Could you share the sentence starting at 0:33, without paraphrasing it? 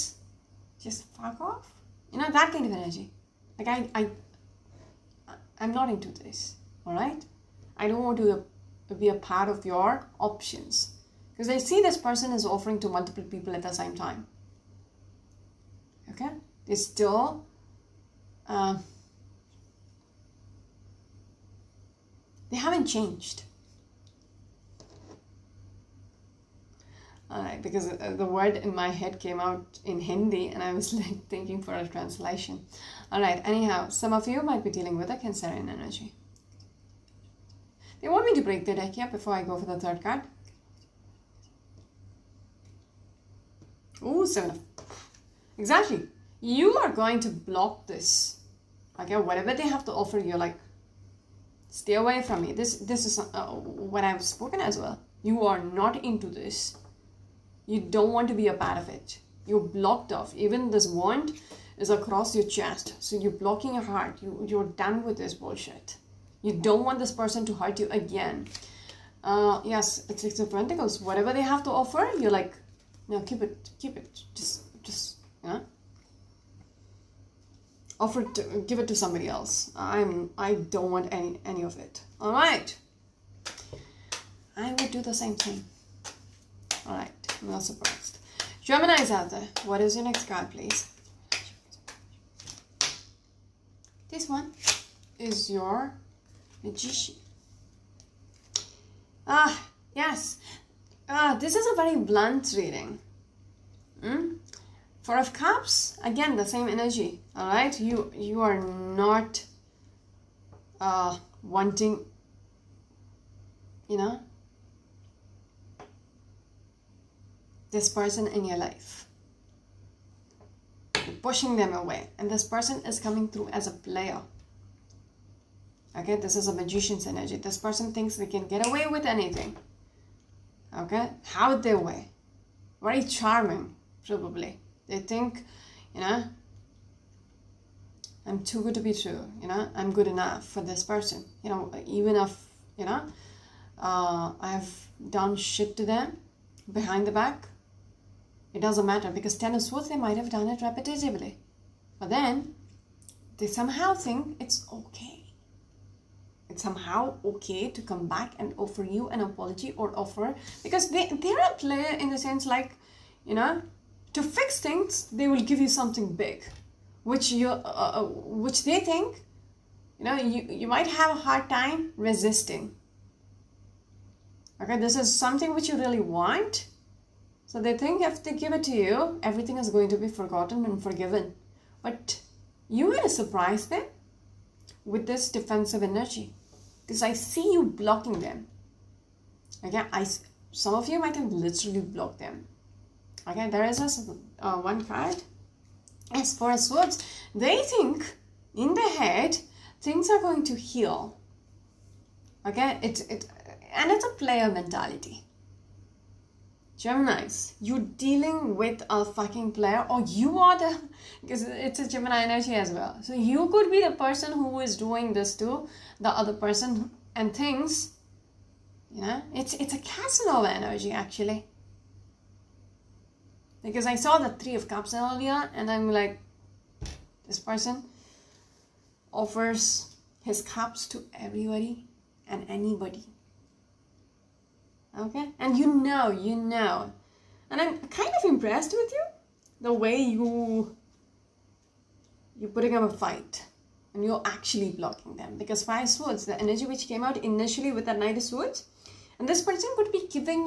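All right, anyhow, some of you might be dealing with a Cancerian energy.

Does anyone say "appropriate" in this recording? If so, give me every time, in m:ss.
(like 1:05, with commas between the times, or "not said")
not said.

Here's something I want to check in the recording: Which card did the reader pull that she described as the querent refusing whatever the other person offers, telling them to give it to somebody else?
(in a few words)
Six of Pentacles.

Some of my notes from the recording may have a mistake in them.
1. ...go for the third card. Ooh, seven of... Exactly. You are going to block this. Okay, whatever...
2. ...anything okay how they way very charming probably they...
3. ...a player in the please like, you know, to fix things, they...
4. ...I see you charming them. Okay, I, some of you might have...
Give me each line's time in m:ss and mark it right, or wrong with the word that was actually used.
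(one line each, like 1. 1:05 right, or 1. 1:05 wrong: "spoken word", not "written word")
1. 0:39 right
2. 2:09 right
3. 2:41 wrong: "sense", not "please"
4. 3:07 wrong: "blocking", not "charming".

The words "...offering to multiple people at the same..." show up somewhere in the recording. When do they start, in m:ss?
0:12.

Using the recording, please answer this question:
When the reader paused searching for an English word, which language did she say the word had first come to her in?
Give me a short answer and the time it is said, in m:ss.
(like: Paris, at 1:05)
Hindi, at 0:29.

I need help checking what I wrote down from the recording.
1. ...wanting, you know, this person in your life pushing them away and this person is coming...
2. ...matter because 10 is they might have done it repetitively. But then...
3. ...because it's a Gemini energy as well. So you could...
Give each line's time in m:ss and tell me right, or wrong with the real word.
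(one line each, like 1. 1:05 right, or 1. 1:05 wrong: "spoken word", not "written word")
1. 1:51 right
2. 2:28 right
3. 3:31 right.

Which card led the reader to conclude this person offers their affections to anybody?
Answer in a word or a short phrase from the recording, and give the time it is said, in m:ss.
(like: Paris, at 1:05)
Three of Cups, at 3:44.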